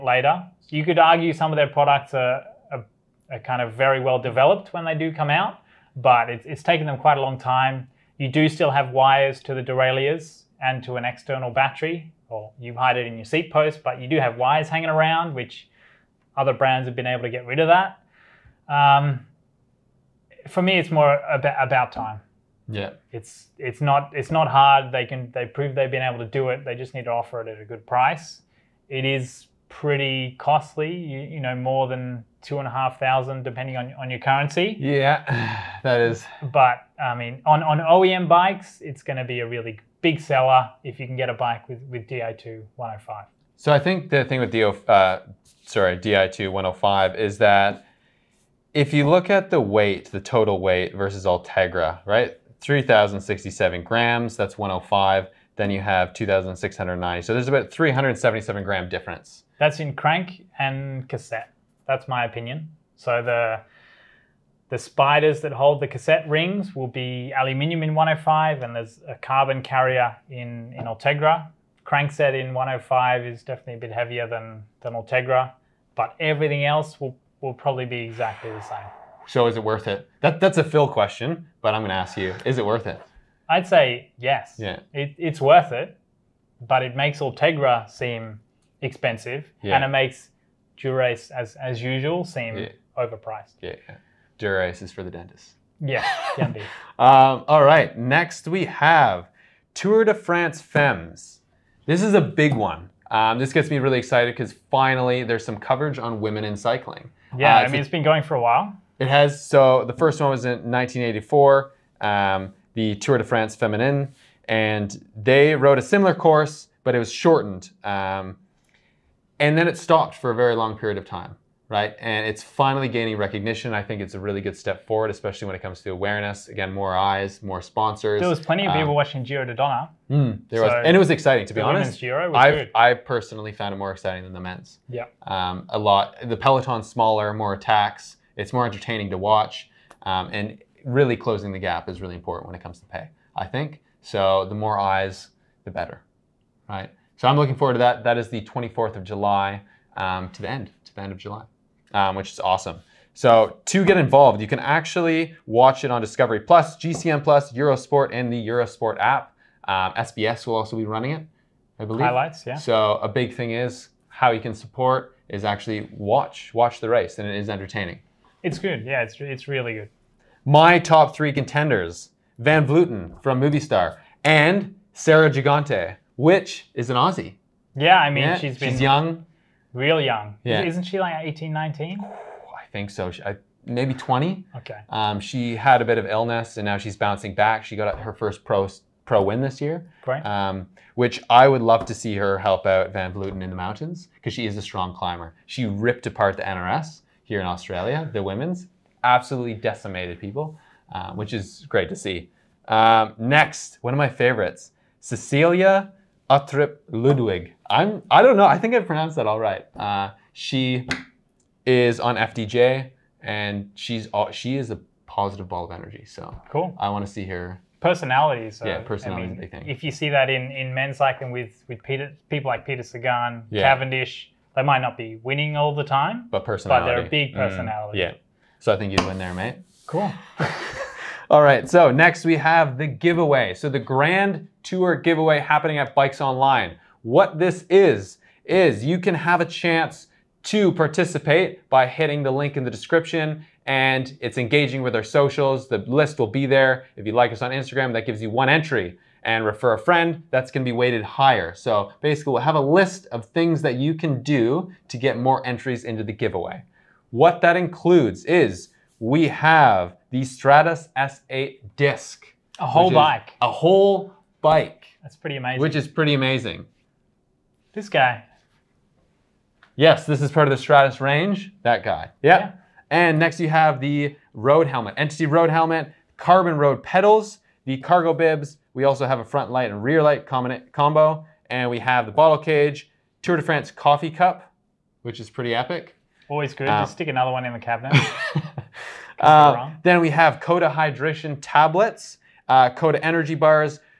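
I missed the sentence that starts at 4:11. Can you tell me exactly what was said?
So basically we'll have a list of things that you can do to get more entries into the giveaway.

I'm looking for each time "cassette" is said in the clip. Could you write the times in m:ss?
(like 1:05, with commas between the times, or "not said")
1:01, 1:05.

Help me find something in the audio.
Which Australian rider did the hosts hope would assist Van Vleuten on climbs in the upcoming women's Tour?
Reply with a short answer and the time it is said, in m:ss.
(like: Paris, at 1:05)
Sarah Gigante, at 2:54.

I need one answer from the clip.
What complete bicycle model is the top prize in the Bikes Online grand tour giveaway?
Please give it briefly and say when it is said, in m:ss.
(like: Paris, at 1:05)
Strattos S8 disc, at 4:20.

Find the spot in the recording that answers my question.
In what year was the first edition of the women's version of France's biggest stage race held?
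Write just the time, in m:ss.
1:50.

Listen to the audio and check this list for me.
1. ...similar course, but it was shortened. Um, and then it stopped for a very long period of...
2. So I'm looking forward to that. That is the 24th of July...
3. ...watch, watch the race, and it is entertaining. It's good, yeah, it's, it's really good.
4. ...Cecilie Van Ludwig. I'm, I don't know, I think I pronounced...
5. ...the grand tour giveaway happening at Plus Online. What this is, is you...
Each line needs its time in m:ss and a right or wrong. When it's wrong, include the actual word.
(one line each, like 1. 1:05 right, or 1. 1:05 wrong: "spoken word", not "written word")
1. 1:55 right
2. 2:27 right
3. 2:45 right
4. 3:25 wrong: "Uttrup", not "Van"
5. 3:53 wrong: "Bikes", not "Plus".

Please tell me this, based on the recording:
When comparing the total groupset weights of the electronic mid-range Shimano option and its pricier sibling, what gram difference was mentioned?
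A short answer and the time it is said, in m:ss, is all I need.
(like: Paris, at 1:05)
377 grams, at 0:57.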